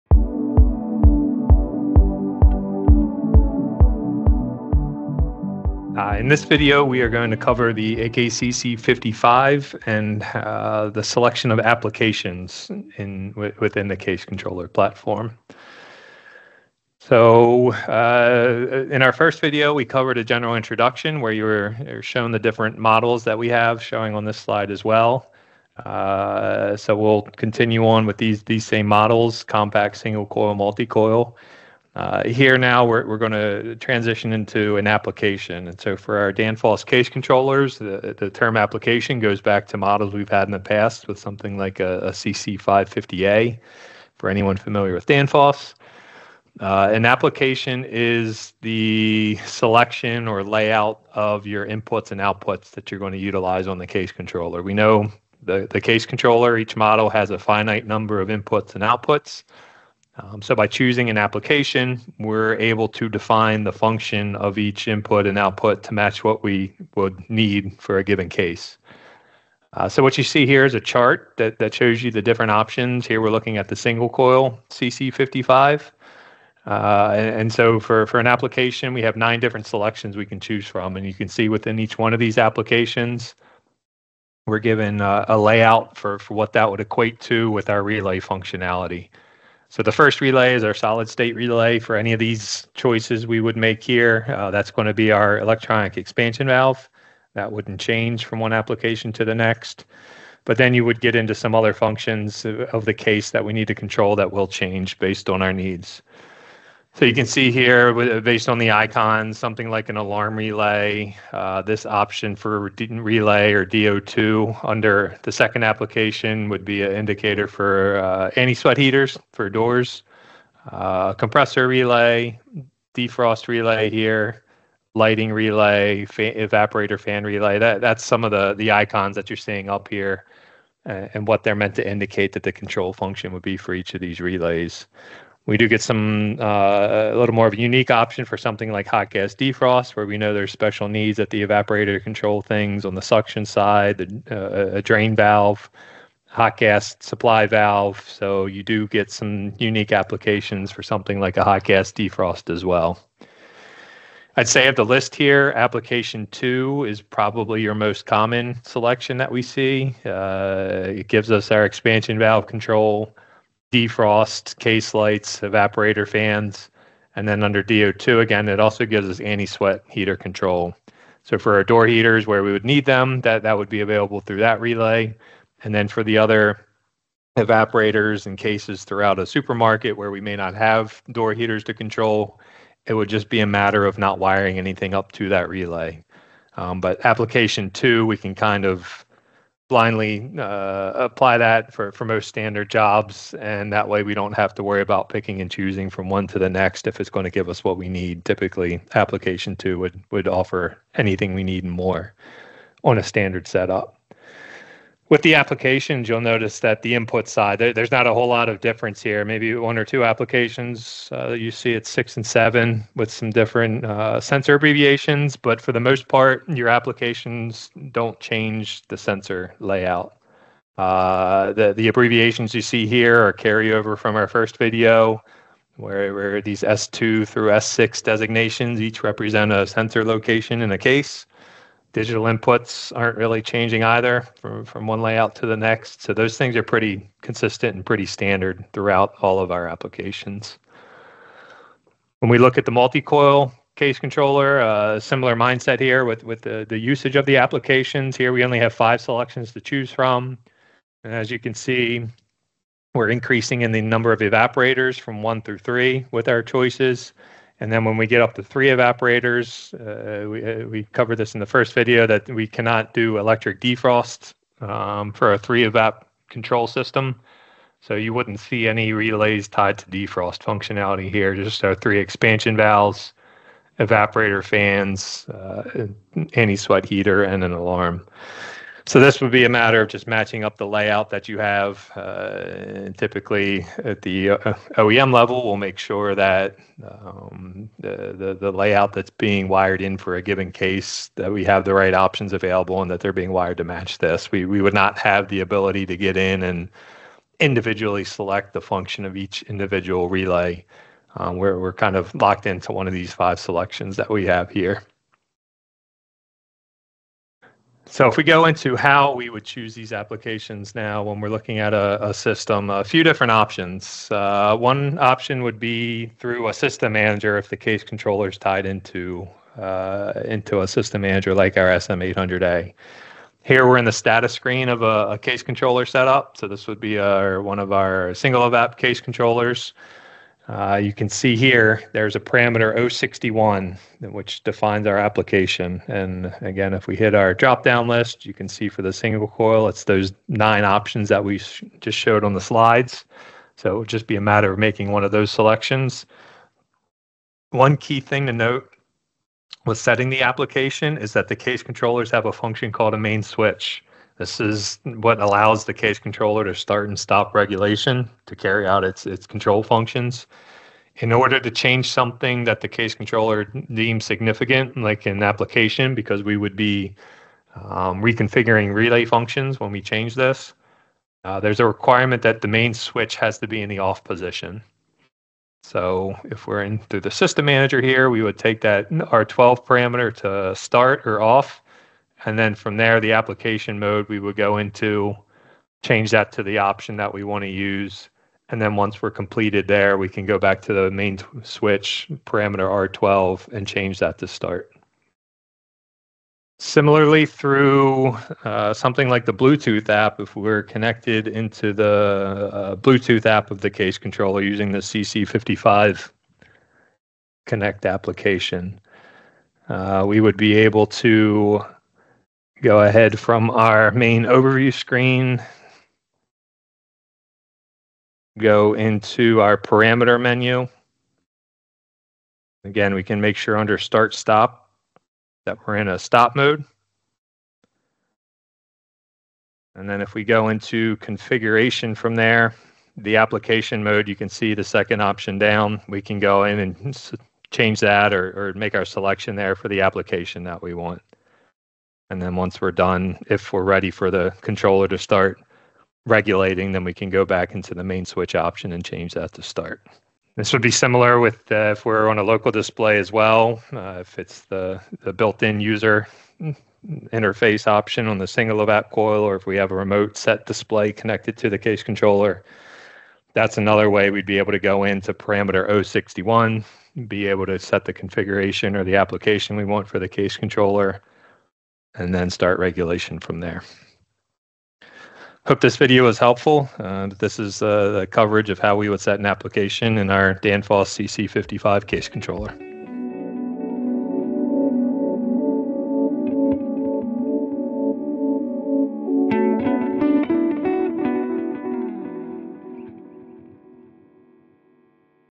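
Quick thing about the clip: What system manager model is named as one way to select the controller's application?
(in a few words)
SM800A.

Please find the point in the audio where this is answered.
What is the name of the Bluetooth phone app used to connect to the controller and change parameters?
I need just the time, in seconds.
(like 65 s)
404 s.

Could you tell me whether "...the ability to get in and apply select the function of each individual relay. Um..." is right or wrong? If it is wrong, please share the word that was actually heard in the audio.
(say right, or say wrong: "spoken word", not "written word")
wrong: "individually", not "apply".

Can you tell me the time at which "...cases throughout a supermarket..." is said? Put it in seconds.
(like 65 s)
178 s.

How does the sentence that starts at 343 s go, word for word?
So it would just be a matter of making one of those selections.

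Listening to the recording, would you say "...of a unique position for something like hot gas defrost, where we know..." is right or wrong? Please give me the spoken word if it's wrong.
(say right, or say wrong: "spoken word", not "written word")
wrong: "option", not "position".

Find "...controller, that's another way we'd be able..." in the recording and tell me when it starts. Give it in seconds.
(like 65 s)
461 s.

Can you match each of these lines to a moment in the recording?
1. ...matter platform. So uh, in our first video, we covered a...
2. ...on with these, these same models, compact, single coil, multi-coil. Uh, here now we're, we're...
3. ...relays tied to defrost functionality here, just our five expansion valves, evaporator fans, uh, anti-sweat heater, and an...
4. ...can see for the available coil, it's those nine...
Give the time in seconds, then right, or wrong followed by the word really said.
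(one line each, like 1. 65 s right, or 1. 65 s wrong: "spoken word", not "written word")
1. 14 s wrong: "controller", not "matter"
2. 27 s right
3. 268 s wrong: "three", not "five"
4. 338 s wrong: "single", not "available".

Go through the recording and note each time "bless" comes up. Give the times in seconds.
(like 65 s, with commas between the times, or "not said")
not said.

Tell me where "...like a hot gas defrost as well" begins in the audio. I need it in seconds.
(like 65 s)
151 s.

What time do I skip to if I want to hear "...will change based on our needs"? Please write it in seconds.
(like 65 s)
104 s.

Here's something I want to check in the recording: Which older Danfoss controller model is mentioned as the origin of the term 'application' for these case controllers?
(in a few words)
CC550A.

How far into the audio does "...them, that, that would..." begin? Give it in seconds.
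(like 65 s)
172 s.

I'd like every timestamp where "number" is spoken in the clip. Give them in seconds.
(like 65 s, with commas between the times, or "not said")
57 s, 253 s.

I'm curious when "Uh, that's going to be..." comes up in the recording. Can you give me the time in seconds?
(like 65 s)
94 s.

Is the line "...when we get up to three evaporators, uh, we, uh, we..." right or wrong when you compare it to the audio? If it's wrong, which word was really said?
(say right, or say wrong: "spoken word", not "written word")
right.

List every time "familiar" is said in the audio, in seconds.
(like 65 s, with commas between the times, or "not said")
44 s.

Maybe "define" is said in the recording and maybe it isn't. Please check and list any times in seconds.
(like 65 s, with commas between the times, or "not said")
63 s, 334 s.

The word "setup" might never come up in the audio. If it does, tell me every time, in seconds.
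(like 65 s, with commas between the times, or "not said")
203 s, 325 s.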